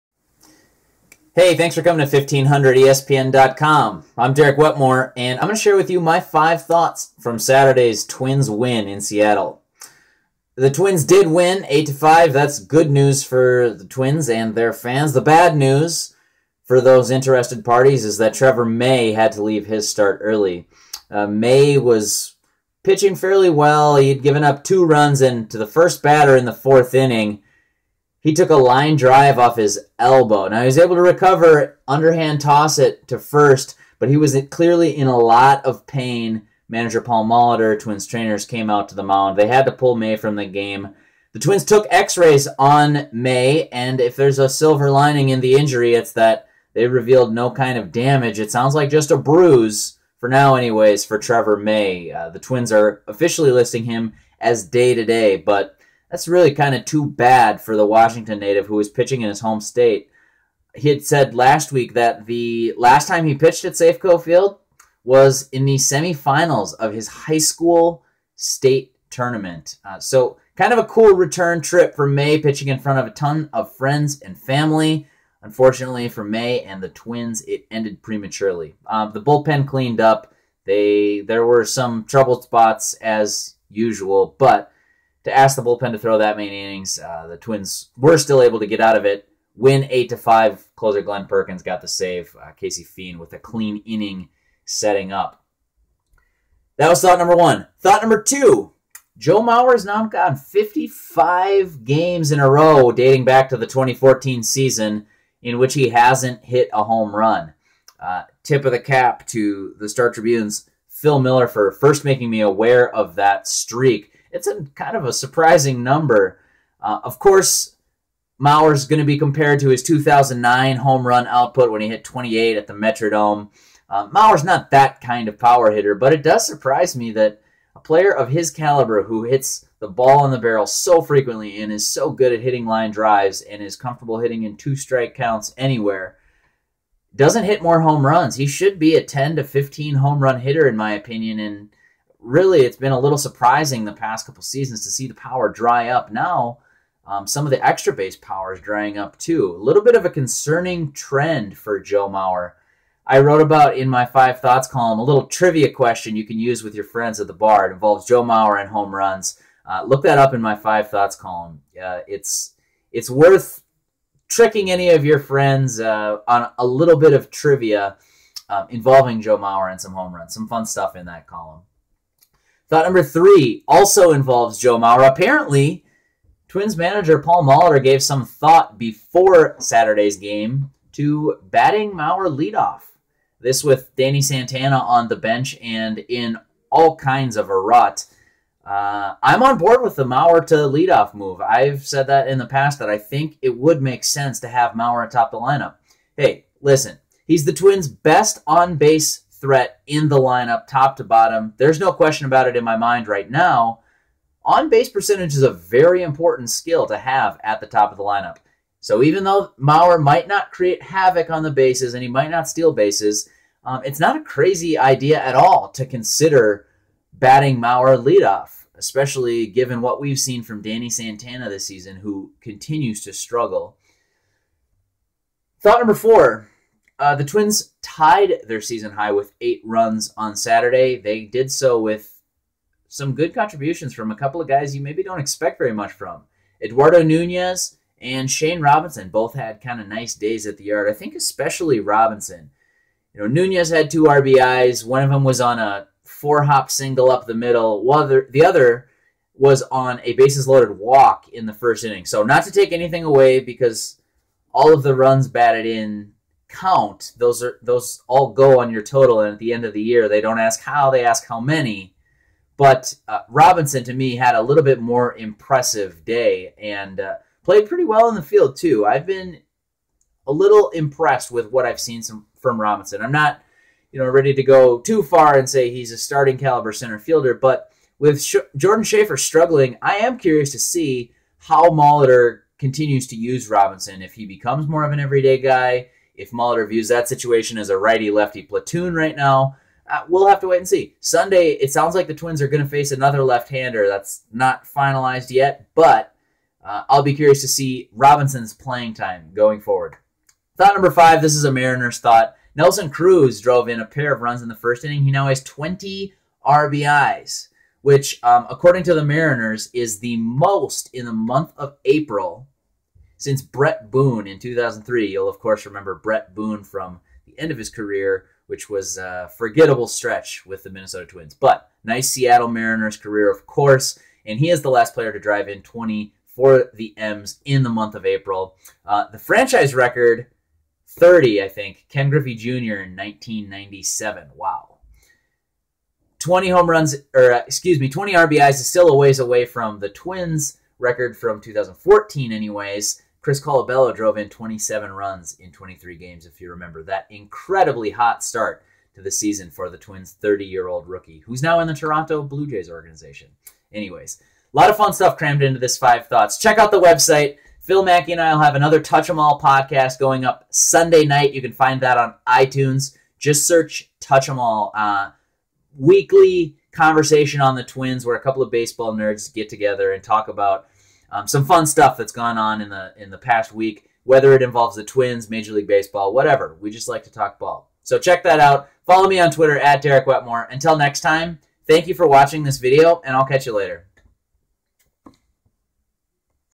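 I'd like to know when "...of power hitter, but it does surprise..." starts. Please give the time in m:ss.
2:05.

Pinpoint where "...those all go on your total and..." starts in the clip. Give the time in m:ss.
4:17.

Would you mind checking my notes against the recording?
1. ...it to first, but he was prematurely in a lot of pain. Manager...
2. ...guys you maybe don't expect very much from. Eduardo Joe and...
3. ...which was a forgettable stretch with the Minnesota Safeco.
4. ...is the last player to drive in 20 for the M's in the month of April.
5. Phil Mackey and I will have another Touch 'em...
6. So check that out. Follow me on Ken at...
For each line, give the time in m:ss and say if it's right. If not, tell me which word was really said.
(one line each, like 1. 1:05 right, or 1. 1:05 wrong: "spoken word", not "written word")
1. 0:32 wrong: "clearly", not "prematurely"
2. 3:54 wrong: "Nunez", not "Joe"
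3. 5:18 wrong: "Twins", not "Safeco"
4. 5:24 right
5. 5:57 right
6. 6:17 wrong: "Twitter", not "Ken".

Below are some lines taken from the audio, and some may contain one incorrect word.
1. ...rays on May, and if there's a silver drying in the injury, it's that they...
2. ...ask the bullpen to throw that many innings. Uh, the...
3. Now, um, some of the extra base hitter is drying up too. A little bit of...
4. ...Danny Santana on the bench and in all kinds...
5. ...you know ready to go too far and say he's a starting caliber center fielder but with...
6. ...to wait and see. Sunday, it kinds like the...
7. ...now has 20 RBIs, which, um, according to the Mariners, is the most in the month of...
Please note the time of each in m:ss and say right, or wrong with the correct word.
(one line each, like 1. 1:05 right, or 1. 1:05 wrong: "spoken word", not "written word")
1. 0:42 wrong: "lining", not "drying"
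2. 1:25 right
3. 2:26 wrong: "power", not "hitter"
4. 3:03 right
5. 4:33 right
6. 4:50 wrong: "sounds", not "kinds"
7. 5:05 right.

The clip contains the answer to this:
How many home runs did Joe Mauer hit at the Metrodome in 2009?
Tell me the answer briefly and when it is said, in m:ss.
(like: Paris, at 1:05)
28, at 2:02.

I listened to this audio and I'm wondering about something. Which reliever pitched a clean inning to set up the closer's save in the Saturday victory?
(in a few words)
Casey Fien.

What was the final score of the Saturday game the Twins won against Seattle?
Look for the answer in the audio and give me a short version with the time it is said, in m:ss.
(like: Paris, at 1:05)
8 to 5, at 0:11.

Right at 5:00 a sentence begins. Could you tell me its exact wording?
Thought number five this is a Mariners thought.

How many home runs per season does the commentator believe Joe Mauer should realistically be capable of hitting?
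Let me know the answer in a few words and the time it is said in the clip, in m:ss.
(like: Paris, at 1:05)
10 to 15, at 2:19.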